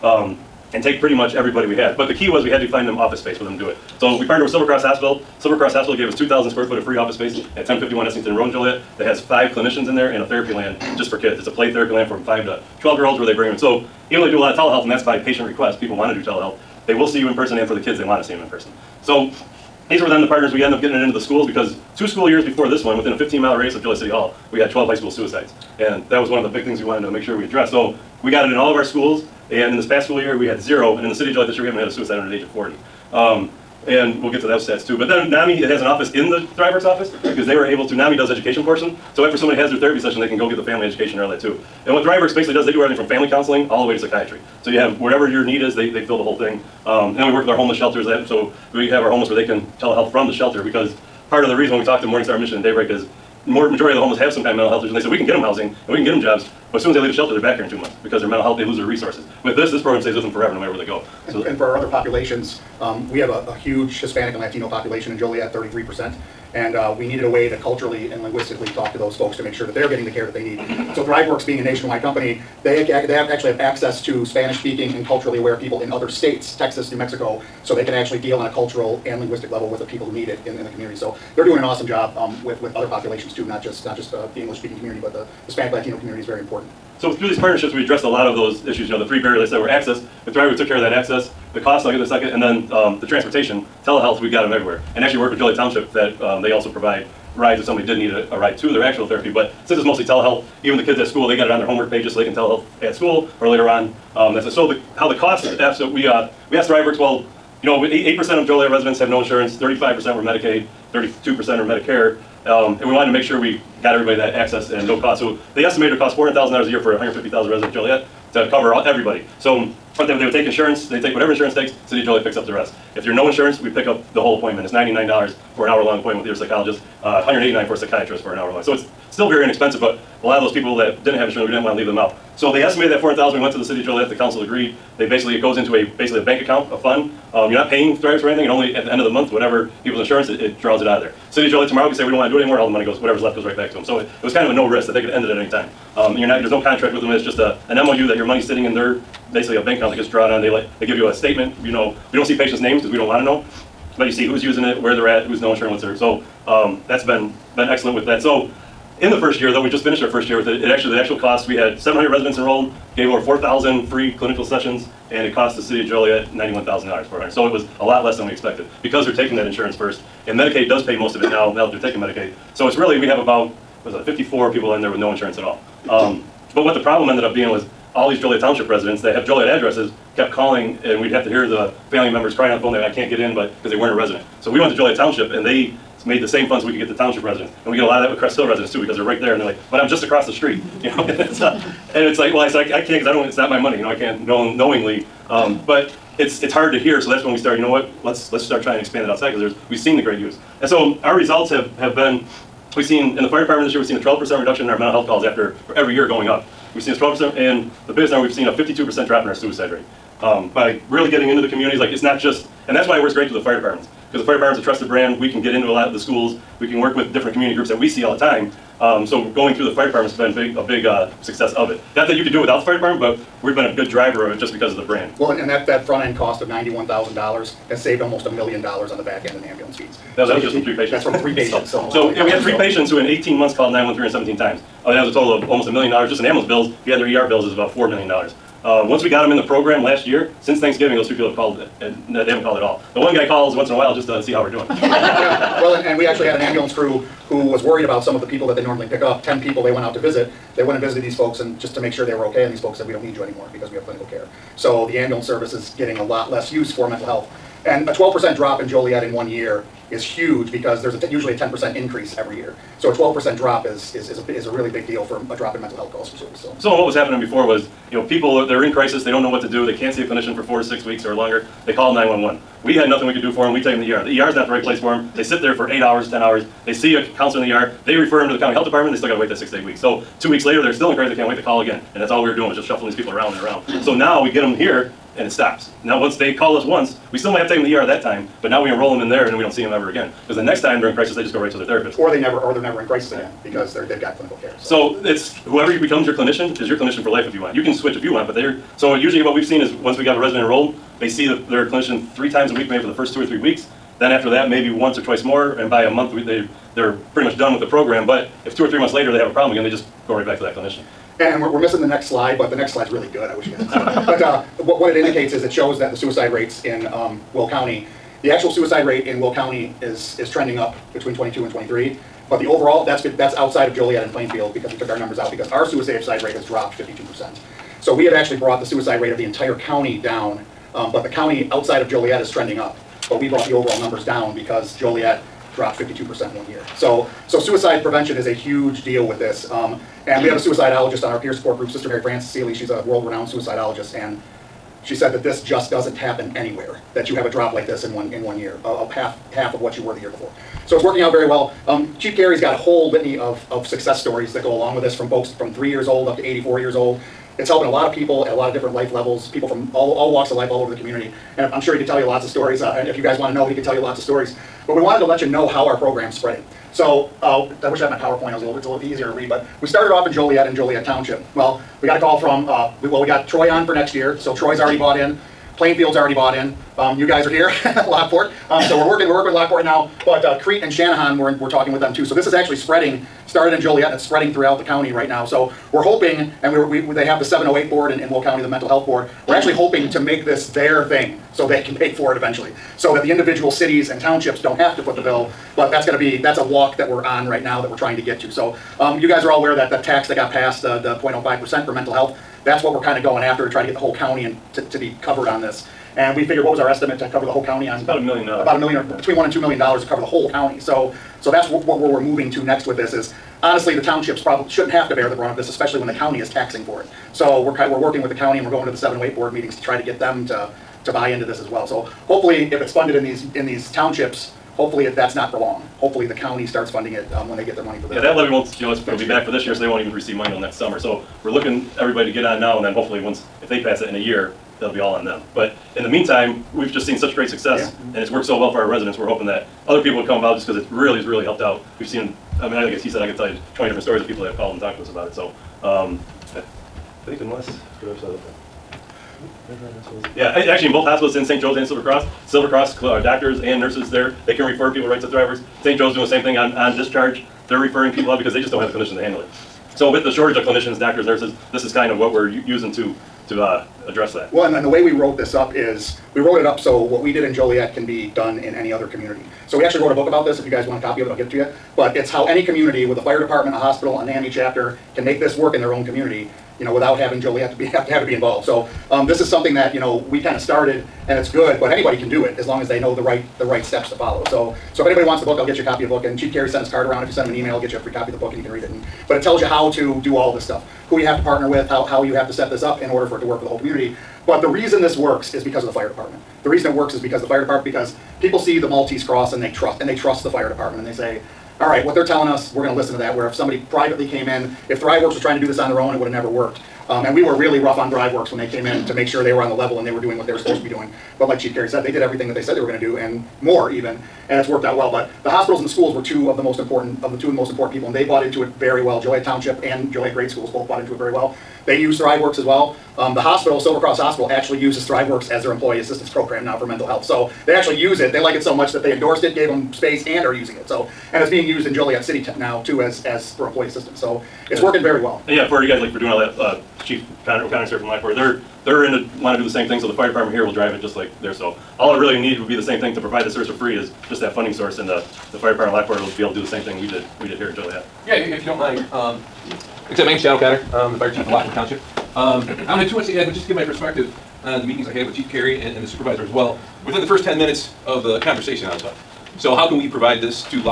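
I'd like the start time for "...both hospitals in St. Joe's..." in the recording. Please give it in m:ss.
7:30.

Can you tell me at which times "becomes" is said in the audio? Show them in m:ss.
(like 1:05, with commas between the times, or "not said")
4:55.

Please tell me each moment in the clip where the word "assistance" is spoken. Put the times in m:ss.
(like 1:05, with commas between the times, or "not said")
8:45, 8:53.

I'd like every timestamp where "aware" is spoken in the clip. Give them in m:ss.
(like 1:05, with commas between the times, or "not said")
1:15, 6:39.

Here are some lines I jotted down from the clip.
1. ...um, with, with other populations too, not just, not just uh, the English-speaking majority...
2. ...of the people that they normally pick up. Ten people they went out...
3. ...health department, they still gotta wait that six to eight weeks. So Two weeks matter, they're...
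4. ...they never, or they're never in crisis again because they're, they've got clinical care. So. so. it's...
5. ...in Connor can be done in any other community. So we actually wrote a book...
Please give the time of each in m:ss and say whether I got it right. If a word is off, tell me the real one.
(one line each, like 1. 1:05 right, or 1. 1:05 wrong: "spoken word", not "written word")
1. 1:22 wrong: "community", not "majority"
2. 4:08 right
3. 4:38 wrong: "later", not "matter"
4. 4:52 right
5. 7:47 wrong: "Joliet", not "Connor".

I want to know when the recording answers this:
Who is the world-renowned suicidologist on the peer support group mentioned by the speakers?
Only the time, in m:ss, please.
5:41.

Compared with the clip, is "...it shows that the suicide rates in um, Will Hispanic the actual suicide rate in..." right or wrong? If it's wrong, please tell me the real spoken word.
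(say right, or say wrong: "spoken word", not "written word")
wrong: "County", not "Hispanic".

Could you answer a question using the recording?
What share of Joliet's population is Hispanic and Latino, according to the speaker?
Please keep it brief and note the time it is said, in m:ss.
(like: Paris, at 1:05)
33%, at 1:05.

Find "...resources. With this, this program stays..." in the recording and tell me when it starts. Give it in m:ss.
0:58.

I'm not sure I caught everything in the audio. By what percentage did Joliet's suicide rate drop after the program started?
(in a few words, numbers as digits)
52%.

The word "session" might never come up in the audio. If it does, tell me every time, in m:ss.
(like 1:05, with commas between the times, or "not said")
0:39, 2:44.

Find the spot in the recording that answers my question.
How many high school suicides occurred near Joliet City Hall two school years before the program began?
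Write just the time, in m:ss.
0:24.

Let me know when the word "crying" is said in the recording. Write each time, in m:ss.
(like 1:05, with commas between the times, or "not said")
3:02.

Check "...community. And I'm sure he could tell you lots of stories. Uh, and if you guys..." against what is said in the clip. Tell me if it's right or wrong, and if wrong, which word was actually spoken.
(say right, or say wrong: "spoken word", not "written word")
right.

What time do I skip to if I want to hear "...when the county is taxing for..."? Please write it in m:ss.
6:55.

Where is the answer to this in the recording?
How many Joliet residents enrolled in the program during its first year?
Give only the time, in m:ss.
2:41.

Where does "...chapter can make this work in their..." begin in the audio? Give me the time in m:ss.
7:54.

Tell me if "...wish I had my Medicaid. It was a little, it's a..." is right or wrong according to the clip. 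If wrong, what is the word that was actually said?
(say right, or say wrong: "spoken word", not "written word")
wrong: "PowerPoint", not "Medicaid".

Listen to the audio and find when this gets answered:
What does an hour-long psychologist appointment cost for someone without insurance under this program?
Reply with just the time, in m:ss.
2:04.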